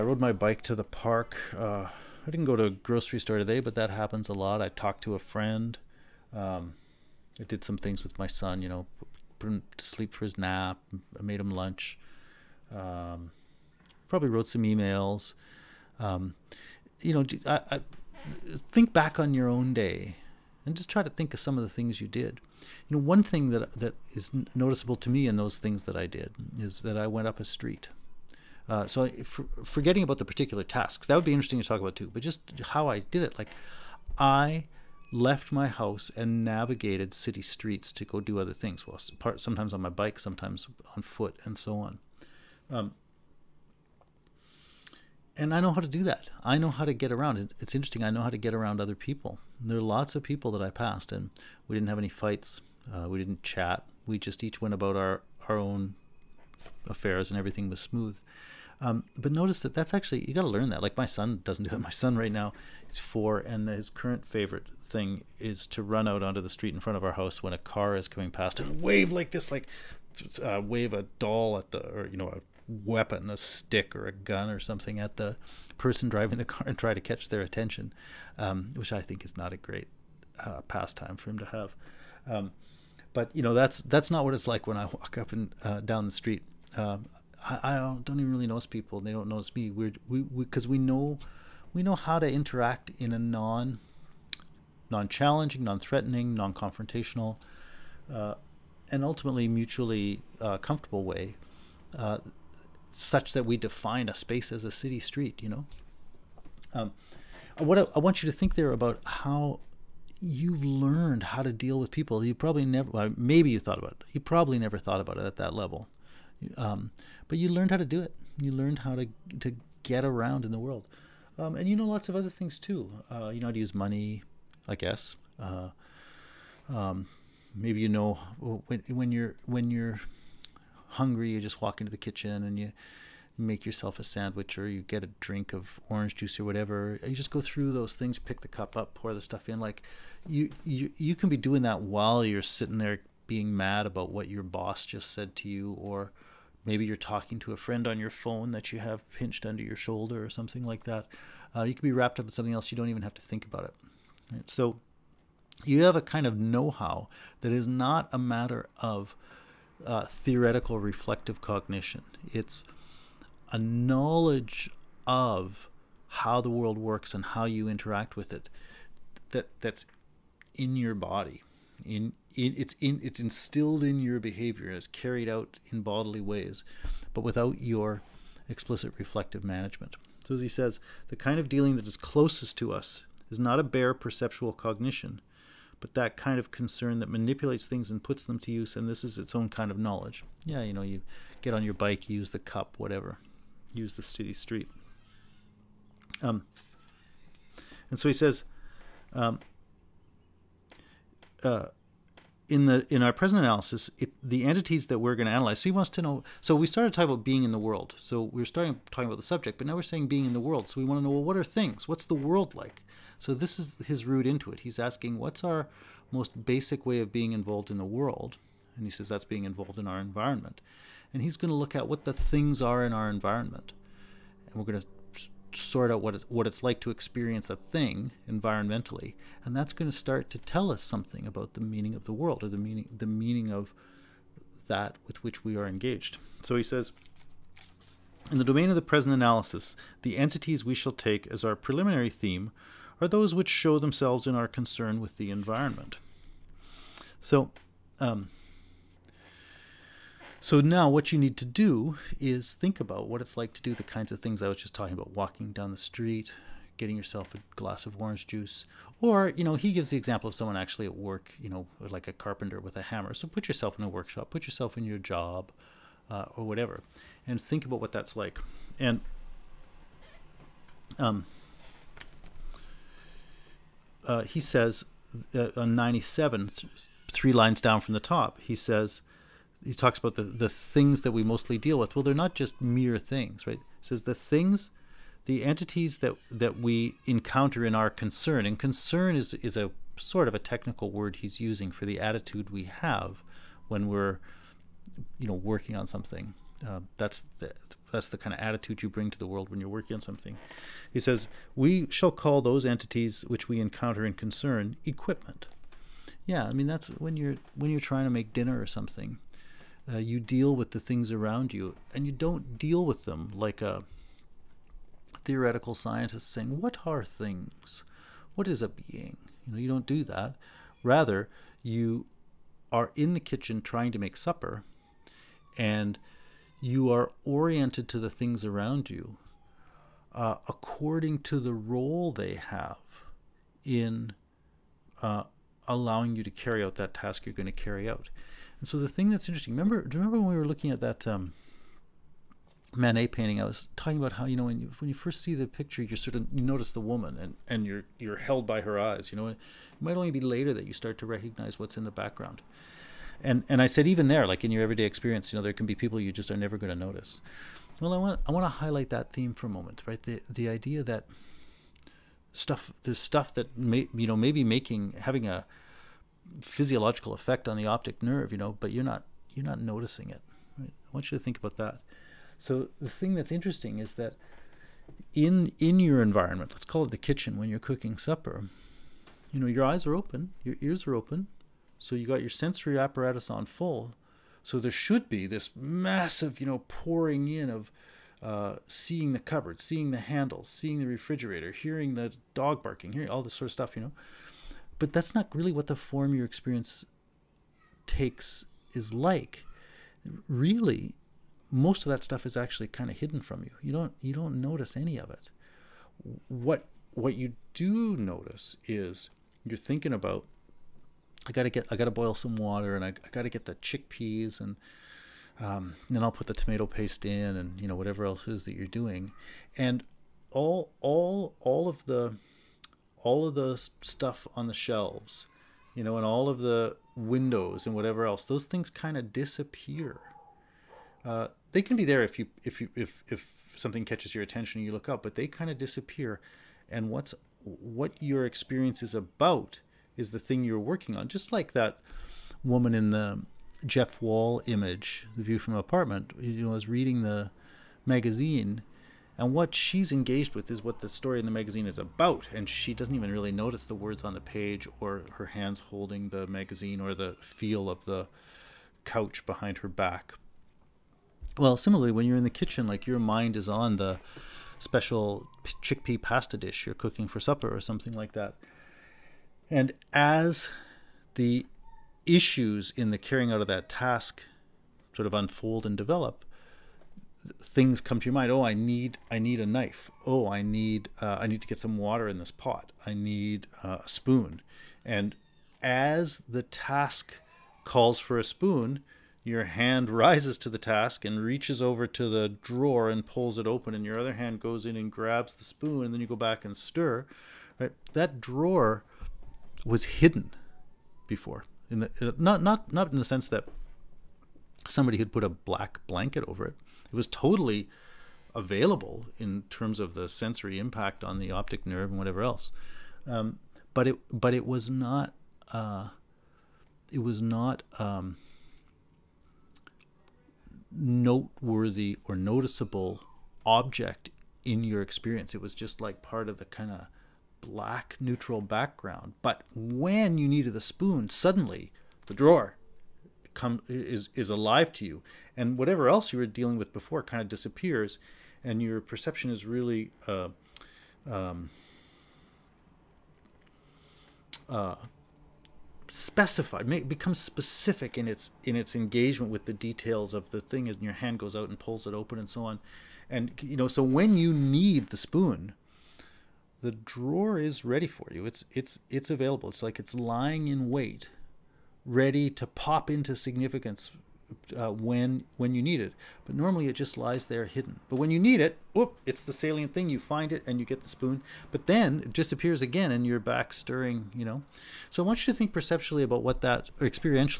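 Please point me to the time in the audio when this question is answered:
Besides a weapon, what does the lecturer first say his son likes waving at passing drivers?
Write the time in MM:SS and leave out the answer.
01:11.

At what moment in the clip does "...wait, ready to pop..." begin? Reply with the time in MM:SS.
09:20.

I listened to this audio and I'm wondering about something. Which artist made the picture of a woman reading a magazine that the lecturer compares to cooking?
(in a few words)
Jeff Wall.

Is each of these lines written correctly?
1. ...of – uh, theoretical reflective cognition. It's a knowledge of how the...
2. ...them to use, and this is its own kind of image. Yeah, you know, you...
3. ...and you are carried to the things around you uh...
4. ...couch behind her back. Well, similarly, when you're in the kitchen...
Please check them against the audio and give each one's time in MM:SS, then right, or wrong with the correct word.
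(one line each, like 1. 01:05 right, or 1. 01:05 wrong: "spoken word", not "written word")
1. 02:38 right
2. 03:08 wrong: "knowledge", not "image"
3. 05:25 wrong: "oriented", not "carried"
4. 07:38 right.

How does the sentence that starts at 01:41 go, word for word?
Uh, such that we define a space as a city street, you know?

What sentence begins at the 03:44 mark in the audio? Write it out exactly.
And we're going to sort out what it's, what it's like to experience a thing environmentally.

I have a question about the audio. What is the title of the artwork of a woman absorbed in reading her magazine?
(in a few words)
The View from an Apartment.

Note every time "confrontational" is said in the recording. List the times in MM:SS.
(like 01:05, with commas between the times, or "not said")
01:36.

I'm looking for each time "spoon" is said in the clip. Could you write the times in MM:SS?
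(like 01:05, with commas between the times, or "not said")
08:03, 08:08, 08:15, 08:50, 09:14, 09:30.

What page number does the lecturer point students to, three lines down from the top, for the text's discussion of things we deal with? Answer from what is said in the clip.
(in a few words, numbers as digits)
97.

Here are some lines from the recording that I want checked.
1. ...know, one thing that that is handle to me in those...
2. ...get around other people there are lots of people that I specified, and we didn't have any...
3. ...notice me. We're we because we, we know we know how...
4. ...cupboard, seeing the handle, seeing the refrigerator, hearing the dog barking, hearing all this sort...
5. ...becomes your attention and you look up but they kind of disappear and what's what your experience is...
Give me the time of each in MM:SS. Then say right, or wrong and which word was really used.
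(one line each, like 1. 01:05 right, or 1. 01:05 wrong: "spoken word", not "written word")
1. 00:22 wrong: "noticeable", not "handle"
2. 00:48 wrong: "passed", not "specified"
3. 01:29 right
4. 06:29 right
5. 07:13 wrong: "catches", not "becomes".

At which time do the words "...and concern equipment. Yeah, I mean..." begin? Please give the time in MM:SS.
05:04.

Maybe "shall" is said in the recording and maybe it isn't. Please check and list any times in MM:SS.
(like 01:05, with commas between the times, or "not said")
04:00, 05:01.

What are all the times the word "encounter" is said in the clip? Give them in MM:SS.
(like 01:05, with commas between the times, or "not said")
04:47, 05:03.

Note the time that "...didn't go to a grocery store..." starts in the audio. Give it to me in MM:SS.
00:02.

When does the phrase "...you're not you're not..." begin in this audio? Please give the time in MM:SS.
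06:08.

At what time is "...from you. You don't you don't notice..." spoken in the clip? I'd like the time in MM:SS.
06:43.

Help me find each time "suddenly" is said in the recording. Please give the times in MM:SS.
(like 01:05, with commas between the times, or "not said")
08:51.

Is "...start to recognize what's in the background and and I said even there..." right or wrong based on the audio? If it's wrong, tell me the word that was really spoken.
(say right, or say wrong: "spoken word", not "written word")
right.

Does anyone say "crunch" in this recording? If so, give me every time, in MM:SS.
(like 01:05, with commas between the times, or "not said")
not said.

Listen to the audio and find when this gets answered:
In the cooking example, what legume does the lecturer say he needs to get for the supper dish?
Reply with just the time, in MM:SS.
06:53.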